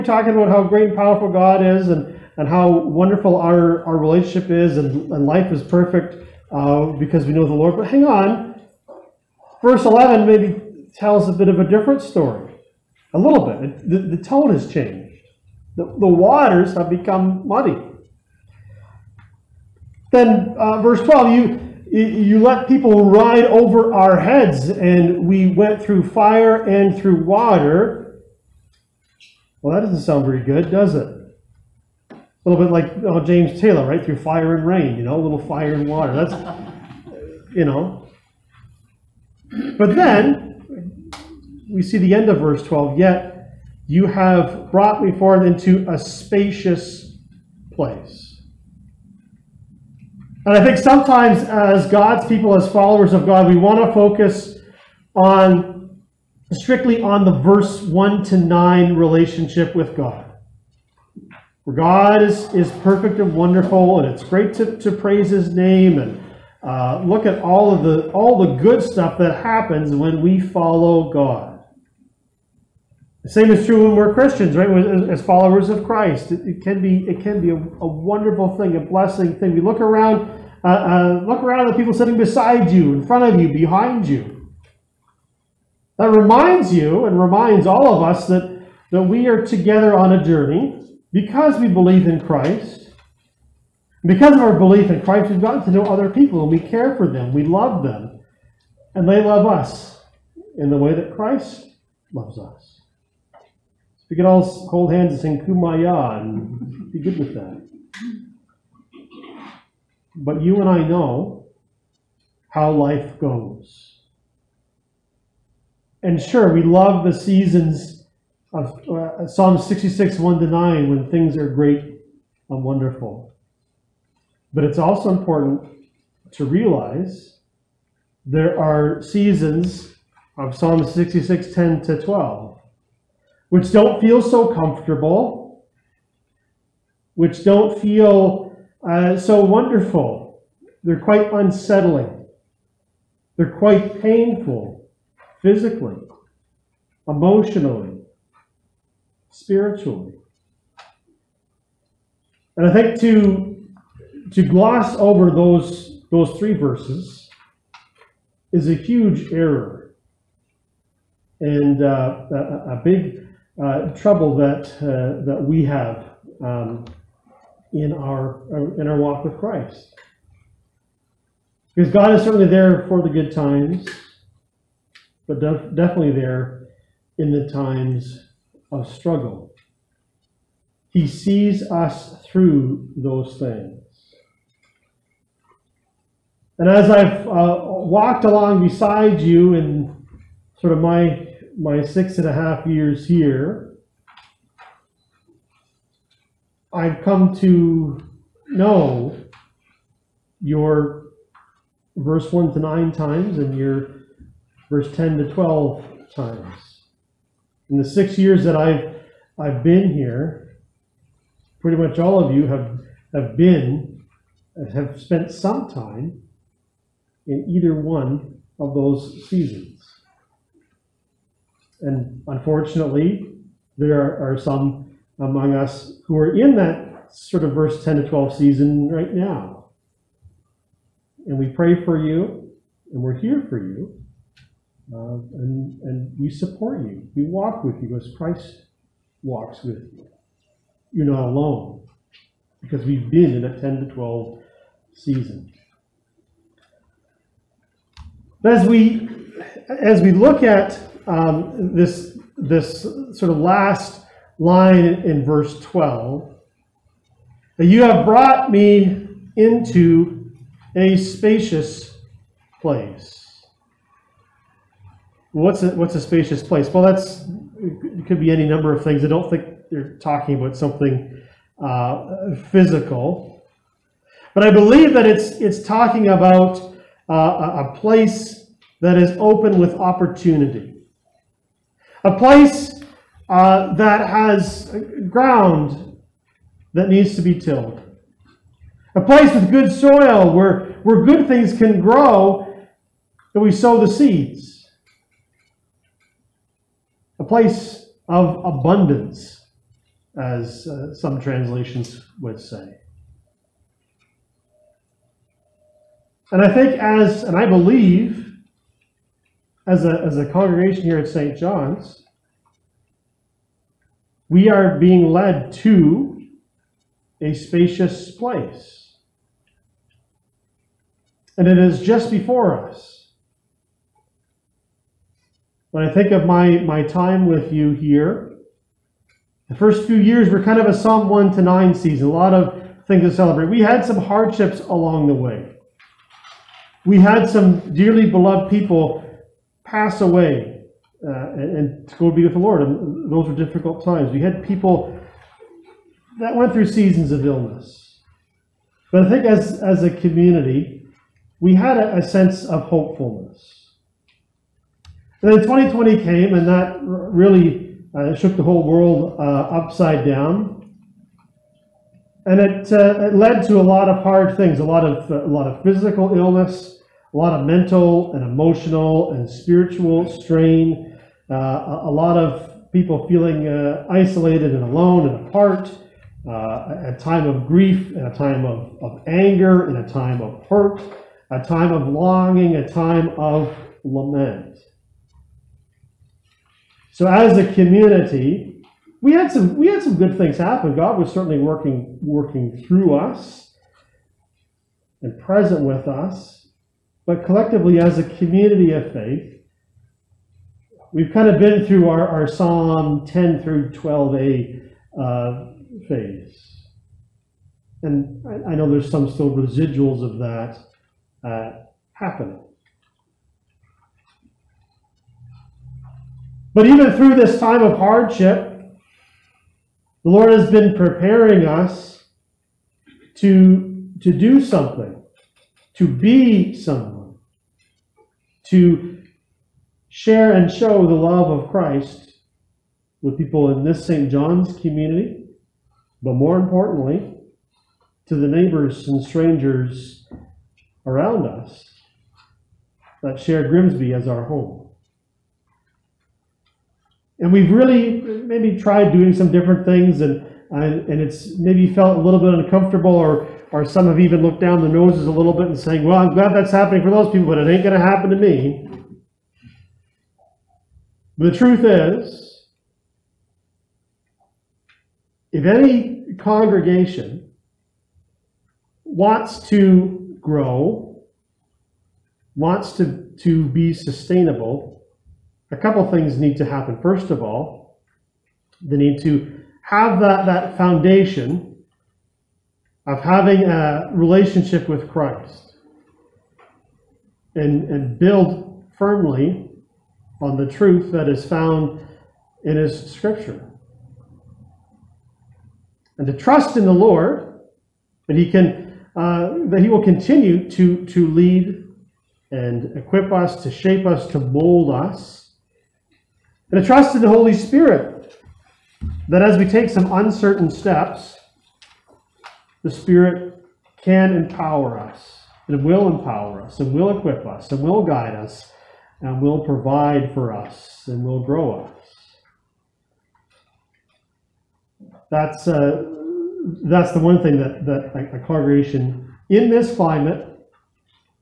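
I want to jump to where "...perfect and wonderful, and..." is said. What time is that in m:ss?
1:02.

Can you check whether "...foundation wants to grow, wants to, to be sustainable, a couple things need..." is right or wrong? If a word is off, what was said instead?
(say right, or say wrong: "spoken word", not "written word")
wrong: "congregation", not "foundation".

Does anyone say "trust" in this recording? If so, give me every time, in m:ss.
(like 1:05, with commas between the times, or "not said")
8:16, 8:26.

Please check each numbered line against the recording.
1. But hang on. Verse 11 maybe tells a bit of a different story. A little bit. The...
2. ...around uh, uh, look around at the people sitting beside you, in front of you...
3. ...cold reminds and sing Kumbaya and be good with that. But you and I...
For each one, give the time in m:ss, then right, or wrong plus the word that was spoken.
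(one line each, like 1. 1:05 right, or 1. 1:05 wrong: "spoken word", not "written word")
1. 0:07 right
2. 1:19 right
3. 1:44 wrong: "hands", not "reminds".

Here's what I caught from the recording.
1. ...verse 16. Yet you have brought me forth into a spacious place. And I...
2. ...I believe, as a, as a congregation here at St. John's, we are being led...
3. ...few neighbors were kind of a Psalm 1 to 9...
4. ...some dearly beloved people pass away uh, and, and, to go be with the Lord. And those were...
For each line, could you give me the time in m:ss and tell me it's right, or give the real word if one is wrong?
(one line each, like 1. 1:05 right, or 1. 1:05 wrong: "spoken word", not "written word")
1. 0:42 wrong: "12", not "16"
2. 5:07 right
3. 5:29 wrong: "years", not "neighbors"
4. 5:37 right.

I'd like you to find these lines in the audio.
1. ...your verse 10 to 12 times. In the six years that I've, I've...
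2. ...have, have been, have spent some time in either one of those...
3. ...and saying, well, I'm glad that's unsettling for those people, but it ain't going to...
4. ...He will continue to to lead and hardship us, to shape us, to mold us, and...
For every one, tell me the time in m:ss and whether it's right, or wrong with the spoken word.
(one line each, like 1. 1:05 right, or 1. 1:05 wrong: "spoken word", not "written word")
1. 3:23 right
2. 3:32 right
3. 7:35 wrong: "happening", not "unsettling"
4. 8:19 wrong: "equip", not "hardship".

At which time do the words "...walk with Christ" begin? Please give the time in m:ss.
2:48.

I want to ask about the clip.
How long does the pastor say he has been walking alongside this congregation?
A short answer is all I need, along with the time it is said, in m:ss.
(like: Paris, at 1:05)
6 and a half years, at 3:11.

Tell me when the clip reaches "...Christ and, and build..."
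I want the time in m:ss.
8:04.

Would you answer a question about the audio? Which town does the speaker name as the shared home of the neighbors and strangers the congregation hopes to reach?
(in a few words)
Grimsby.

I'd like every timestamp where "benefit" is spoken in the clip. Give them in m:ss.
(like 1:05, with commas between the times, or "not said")
not said.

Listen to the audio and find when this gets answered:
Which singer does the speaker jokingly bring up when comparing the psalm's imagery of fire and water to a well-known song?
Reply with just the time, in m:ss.
0:33.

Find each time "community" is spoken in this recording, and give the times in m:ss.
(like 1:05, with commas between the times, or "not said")
5:49, 6:27, 6:38, 7:14.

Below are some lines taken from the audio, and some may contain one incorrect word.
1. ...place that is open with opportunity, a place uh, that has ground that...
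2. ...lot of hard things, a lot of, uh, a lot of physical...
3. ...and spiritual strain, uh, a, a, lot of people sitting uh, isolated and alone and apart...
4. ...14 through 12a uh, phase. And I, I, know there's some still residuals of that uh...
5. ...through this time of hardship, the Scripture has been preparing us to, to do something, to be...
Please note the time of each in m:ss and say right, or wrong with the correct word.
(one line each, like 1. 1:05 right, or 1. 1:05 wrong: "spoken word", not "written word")
1. 4:37 right
2. 6:03 right
3. 6:09 wrong: "feeling", not "sitting"
4. 6:43 wrong: "10", not "14"
5. 6:56 wrong: "Lord", not "Scripture".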